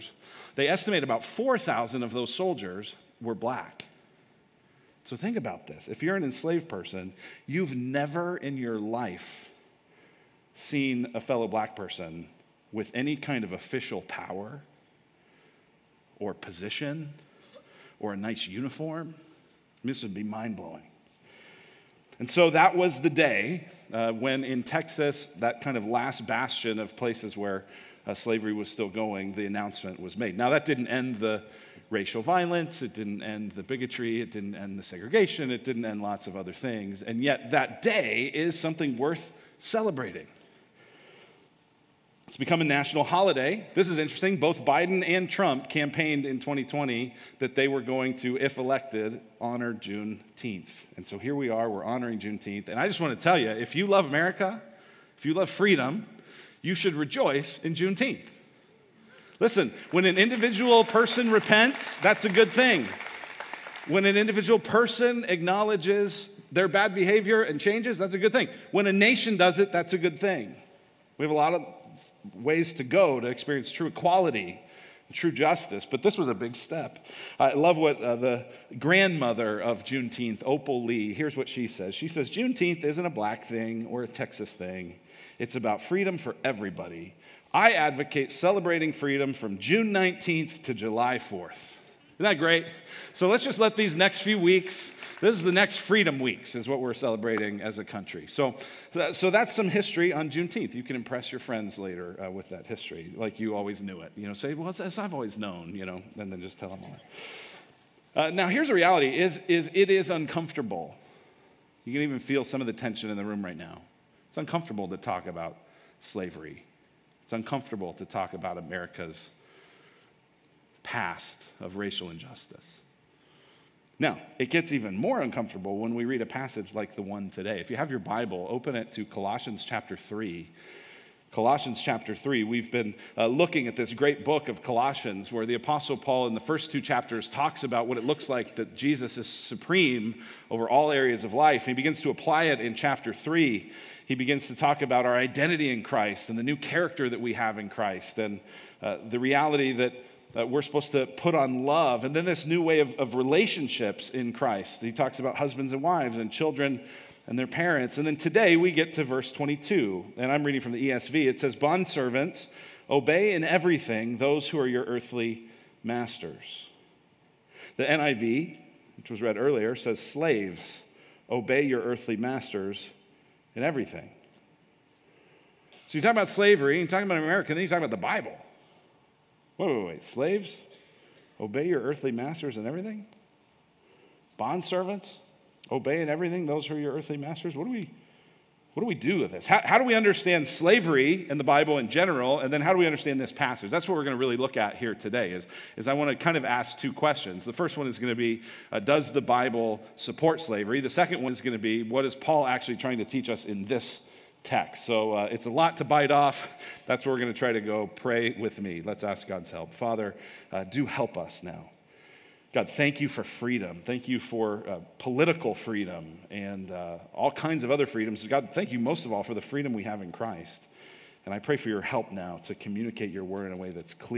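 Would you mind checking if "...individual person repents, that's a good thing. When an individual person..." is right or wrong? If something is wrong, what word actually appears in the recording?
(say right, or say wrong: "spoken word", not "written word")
right.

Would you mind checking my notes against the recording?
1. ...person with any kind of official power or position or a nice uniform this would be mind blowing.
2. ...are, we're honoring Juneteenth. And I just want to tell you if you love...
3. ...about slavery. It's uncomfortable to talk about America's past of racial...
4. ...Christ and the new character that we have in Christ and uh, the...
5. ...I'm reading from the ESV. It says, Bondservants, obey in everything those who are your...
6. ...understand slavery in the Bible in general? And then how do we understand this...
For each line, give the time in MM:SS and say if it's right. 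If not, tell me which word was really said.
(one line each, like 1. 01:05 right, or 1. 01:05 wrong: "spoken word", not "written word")
1. 00:11 right
2. 00:51 right
3. 01:55 right
4. 02:25 right
5. 02:40 right
6. 03:09 right.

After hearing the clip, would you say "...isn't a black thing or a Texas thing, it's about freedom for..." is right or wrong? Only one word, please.
right.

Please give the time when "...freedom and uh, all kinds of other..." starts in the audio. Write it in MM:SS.
03:35.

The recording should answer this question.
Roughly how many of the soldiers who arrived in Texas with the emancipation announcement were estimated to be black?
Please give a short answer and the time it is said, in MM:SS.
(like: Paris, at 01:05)
4,000, at 00:01.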